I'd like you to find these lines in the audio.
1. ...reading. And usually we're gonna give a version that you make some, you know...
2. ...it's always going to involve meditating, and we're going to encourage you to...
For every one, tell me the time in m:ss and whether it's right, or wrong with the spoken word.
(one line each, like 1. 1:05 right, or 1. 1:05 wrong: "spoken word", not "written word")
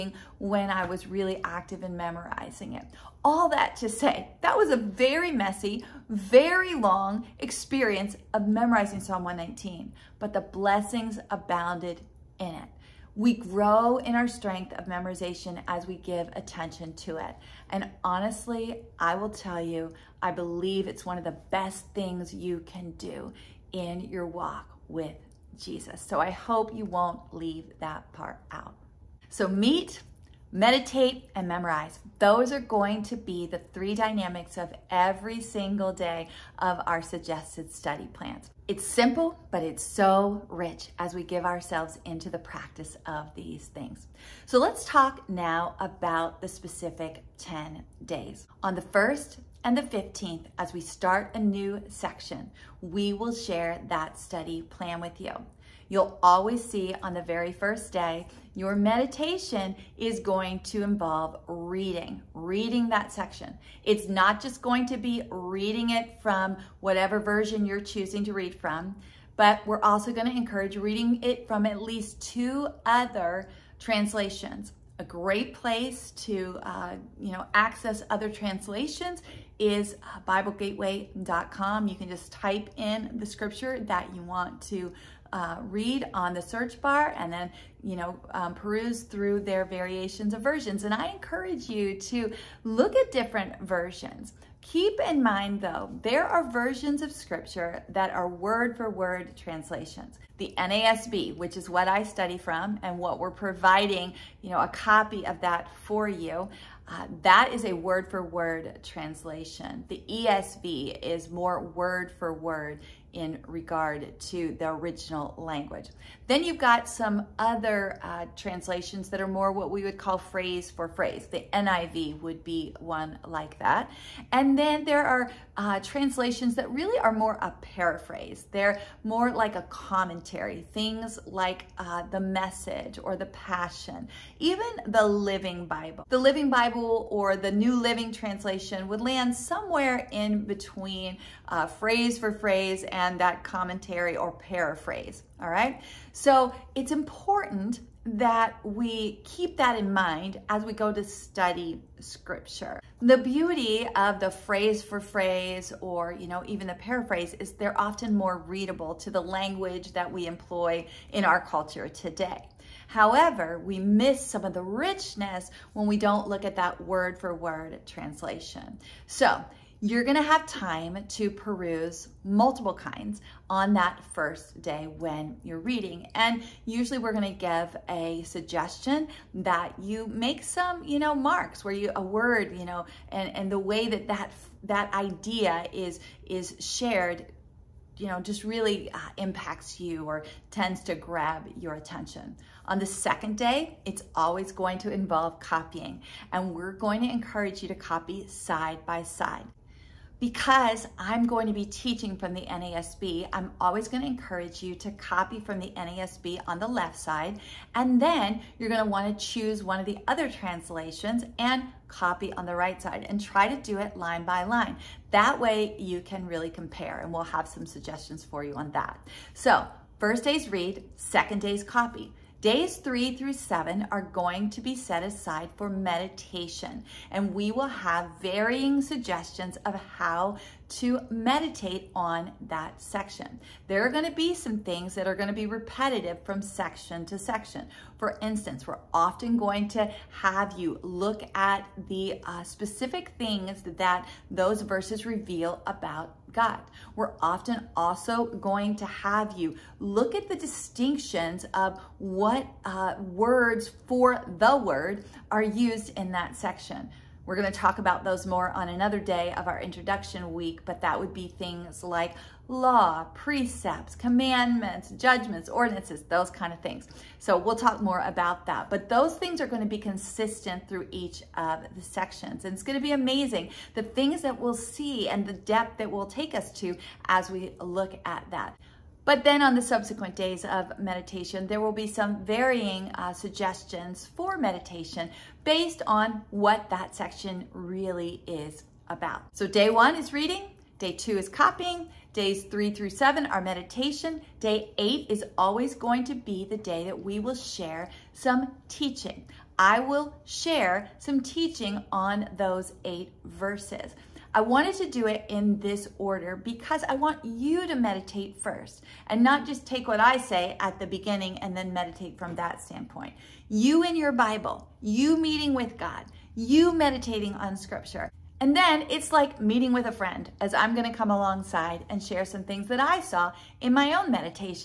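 1. 2:55 wrong: "suggestion", not "version"
2. 3:13 wrong: "copying", not "meditating".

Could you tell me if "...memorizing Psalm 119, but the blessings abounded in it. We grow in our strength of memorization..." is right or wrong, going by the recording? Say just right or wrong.
right.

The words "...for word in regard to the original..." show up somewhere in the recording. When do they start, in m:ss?
1:52.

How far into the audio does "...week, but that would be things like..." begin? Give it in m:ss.
4:20.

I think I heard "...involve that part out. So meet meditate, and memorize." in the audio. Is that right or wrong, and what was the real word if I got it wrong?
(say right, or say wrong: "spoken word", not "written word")
wrong: "leave", not "involve".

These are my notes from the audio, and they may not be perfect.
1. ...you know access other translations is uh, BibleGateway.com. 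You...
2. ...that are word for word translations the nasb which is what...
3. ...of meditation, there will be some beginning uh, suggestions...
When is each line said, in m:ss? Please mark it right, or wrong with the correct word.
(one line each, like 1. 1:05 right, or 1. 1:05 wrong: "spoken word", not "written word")
1. 1:17 right
2. 1:37 right
3. 4:40 wrong: "varying", not "beginning".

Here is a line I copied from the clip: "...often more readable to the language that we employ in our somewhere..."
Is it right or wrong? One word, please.
wrong.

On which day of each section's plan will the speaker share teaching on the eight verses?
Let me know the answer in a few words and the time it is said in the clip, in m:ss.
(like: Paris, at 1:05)
Day 8, at 4:54.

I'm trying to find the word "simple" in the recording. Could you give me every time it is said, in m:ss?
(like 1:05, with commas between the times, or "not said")
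0:38.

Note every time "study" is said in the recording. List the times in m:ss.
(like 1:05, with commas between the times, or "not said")
0:37, 0:54, 1:42, 2:31.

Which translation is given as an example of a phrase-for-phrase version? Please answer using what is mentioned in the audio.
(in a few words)
NIV.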